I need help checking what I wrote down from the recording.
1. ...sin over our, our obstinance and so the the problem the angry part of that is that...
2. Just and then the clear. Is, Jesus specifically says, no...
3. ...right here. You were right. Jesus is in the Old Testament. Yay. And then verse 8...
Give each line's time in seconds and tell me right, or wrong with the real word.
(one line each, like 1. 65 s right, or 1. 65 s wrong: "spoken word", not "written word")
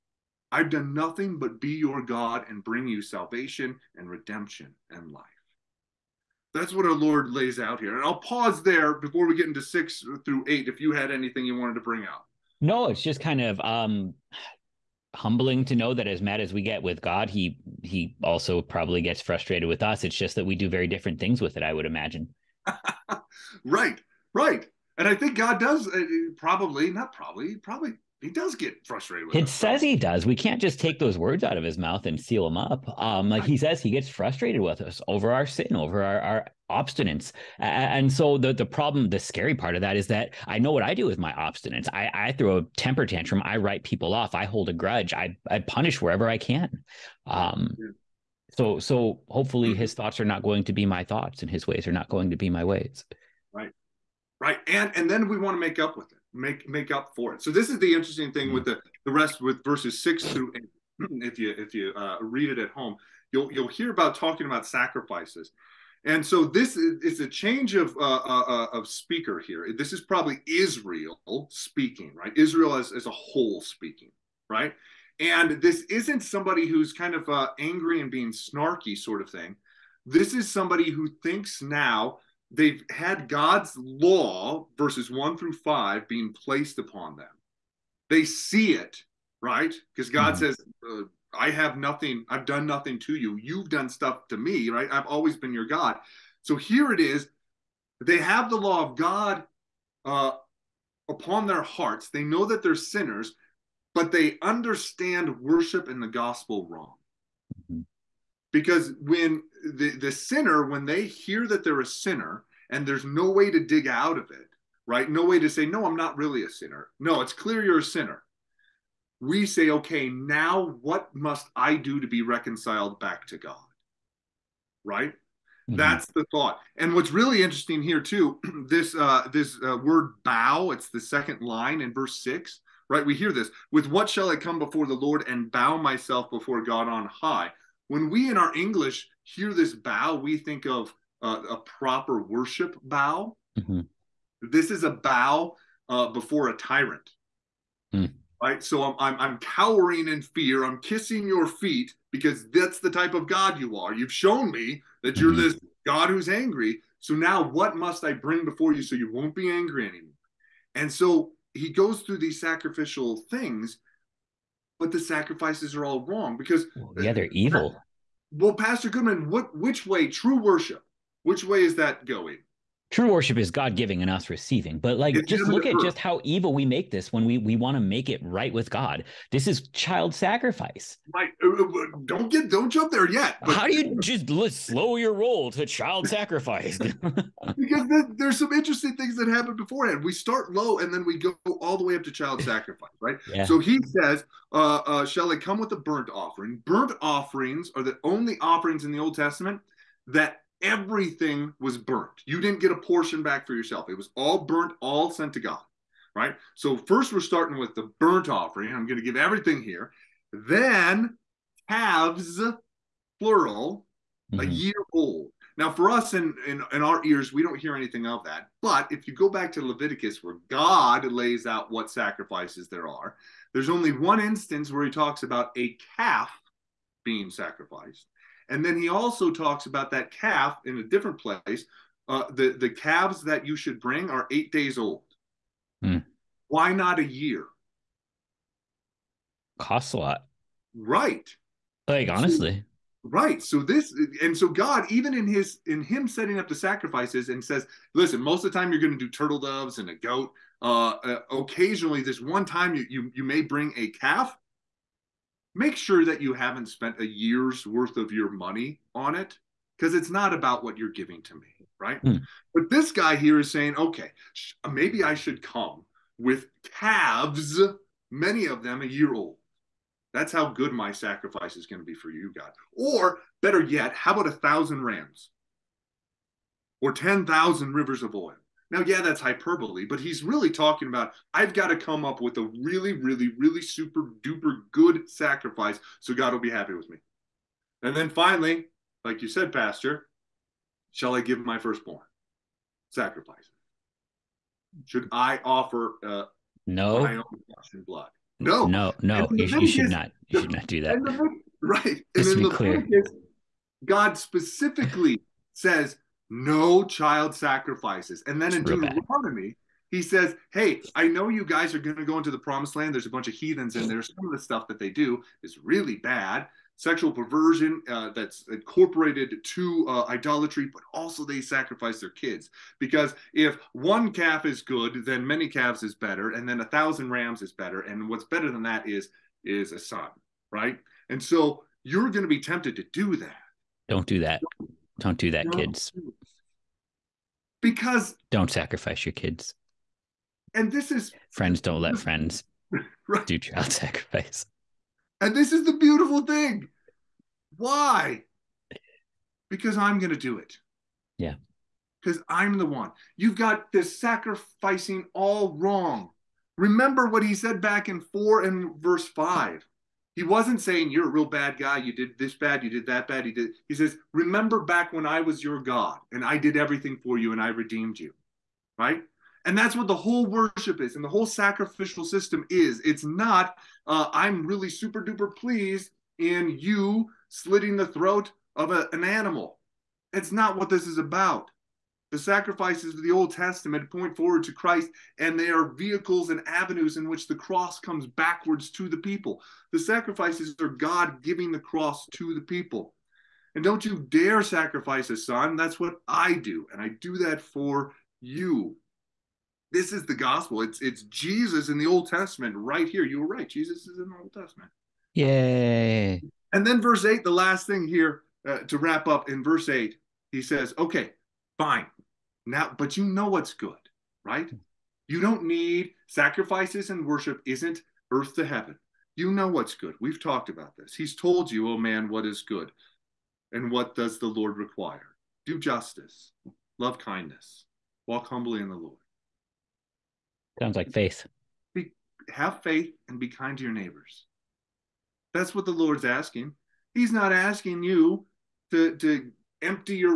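1. 35 s wrong: "scary", not "angry"
2. 302 s wrong: "God", not "Jesus"
3. 402 s right.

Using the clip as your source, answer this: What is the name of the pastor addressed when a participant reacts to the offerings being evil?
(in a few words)
Pastor Goodman.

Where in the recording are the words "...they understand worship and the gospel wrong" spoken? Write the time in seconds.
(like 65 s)
104 s.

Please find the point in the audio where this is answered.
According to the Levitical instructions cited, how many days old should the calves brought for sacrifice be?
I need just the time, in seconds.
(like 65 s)
234 s.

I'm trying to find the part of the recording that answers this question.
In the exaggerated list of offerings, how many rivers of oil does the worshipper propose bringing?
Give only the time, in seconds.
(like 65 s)
276 s.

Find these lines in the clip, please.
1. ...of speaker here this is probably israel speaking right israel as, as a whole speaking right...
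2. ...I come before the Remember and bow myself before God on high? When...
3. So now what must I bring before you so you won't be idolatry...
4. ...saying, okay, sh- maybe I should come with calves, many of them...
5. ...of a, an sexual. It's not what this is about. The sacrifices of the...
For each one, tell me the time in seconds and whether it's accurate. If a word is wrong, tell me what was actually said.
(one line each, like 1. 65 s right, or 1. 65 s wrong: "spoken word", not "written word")
1. 68 s right
2. 134 s wrong: "Lord", not "Remember"
3. 156 s wrong: "angry", not "idolatry"
4. 263 s right
5. 378 s wrong: "animal", not "sexual".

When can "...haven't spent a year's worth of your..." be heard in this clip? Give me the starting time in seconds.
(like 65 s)
256 s.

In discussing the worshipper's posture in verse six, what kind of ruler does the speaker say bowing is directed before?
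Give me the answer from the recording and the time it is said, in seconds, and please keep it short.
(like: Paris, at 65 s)
A tyrant, at 146 s.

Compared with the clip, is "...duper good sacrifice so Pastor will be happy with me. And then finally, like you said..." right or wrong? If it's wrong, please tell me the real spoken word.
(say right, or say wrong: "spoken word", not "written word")
wrong: "God", not "Pastor".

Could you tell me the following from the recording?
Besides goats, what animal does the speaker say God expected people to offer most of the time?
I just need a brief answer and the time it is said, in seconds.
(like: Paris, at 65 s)
Turtle doves, at 249 s.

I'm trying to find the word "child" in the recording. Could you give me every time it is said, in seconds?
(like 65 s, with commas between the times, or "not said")
179 s, 185 s, 192 s, 306 s, 343 s.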